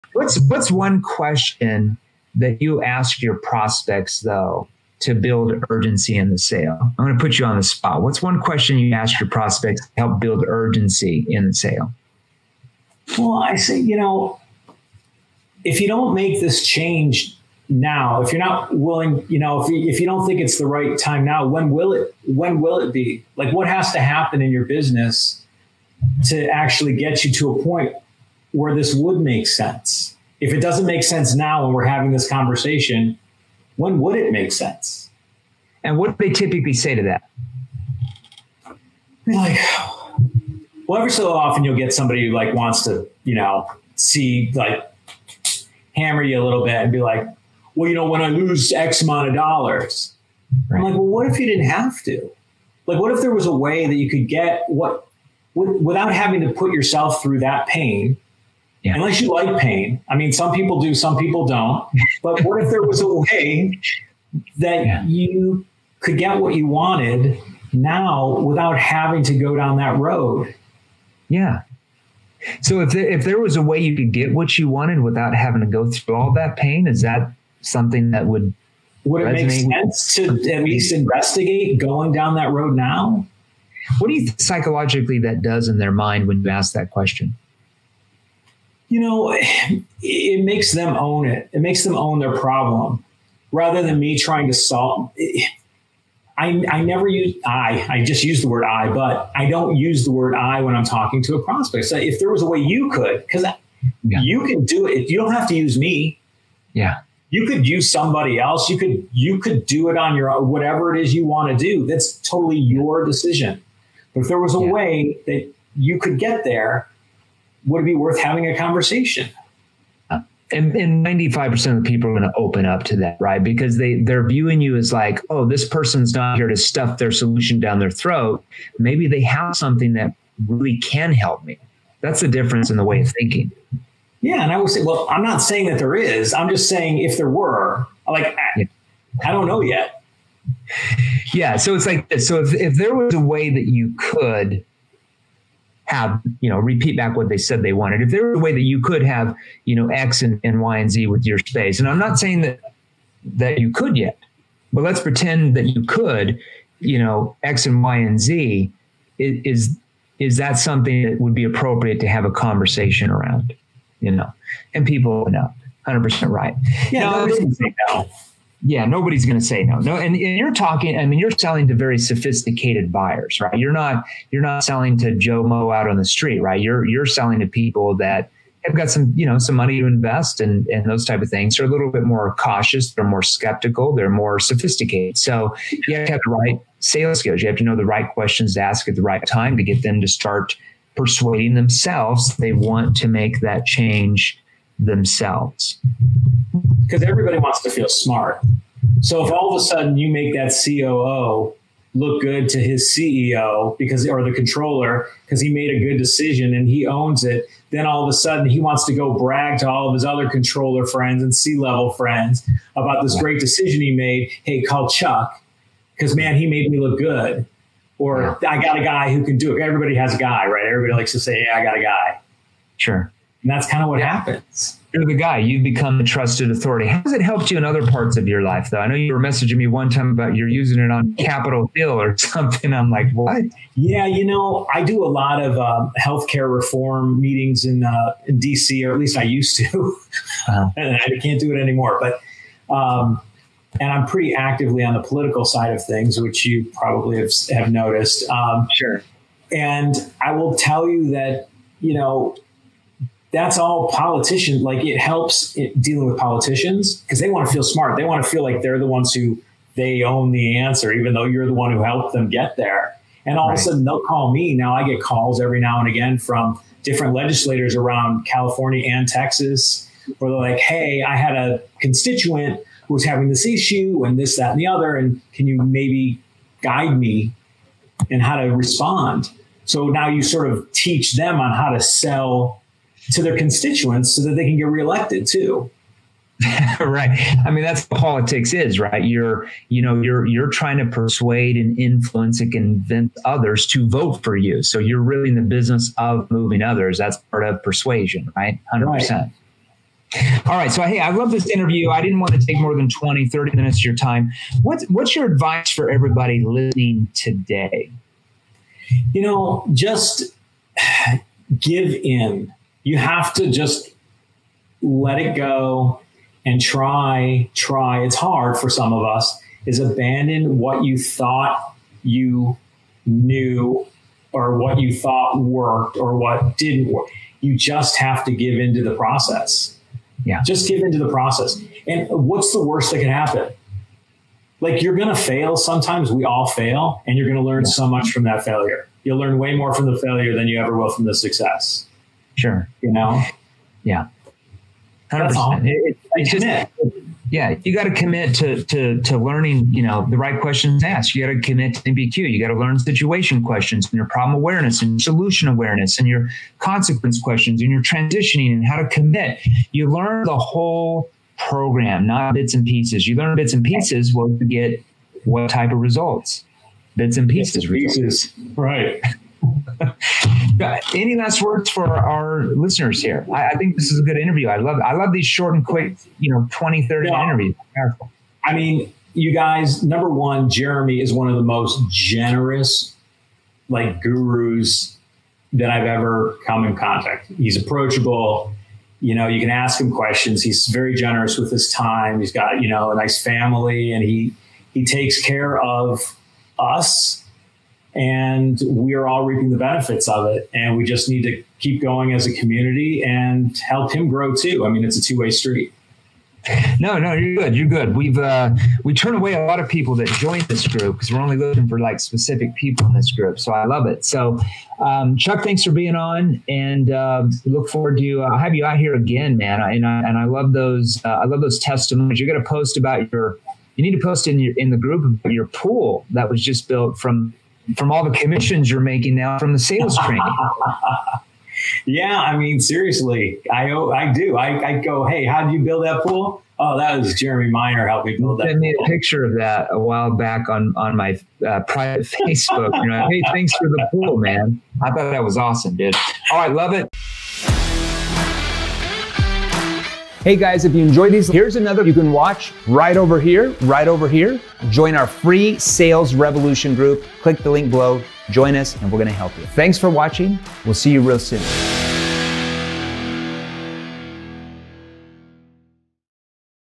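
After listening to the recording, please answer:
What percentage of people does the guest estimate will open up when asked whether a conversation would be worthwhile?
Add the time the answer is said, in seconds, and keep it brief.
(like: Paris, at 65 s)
95%, at 121 s.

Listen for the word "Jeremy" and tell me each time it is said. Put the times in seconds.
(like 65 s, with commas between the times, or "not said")
380 s, 437 s.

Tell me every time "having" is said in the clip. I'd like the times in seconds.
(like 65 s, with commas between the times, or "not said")
31 s, 56 s, 68 s, 75 s, 118 s, 273 s.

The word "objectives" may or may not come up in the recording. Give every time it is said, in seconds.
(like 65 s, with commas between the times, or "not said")
not said.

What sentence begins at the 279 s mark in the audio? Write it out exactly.
So now you sort of teach them on how to sell to their constituents so that they can get reelected too.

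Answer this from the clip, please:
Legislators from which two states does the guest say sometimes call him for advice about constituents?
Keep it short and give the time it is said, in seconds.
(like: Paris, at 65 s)
California and Texas, at 268 s.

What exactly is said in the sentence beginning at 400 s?
And we just need to keep going as a community and help him grow too.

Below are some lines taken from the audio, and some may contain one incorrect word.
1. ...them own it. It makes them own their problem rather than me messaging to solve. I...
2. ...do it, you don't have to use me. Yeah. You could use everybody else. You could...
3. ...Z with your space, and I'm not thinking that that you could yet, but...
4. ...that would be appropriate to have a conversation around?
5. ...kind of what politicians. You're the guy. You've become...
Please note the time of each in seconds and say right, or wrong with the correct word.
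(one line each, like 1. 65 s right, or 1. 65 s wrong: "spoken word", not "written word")
1. 90 s wrong: "trying", not "messaging"
2. 104 s wrong: "somebody", not "everybody"
3. 150 s wrong: "saying", not "thinking"
4. 161 s right
5. 223 s wrong: "happens", not "politicians".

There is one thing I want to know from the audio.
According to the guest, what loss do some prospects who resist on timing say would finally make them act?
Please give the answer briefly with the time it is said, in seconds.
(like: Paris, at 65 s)
When I lose X amount of dollars, at 48 s.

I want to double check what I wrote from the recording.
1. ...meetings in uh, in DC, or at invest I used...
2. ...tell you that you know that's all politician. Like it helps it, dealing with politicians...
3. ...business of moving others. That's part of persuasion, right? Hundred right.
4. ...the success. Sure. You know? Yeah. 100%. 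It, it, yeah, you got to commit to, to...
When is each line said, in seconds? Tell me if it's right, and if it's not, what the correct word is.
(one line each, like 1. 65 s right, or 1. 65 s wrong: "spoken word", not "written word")
1. 237 s wrong: "least", not "invest"
2. 250 s right
3. 295 s right
4. 341 s right.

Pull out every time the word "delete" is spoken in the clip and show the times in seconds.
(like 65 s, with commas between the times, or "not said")
not said.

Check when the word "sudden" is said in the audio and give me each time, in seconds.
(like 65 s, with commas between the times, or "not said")
199 s, 208 s, 263 s.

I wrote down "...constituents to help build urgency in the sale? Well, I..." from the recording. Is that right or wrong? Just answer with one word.
wrong.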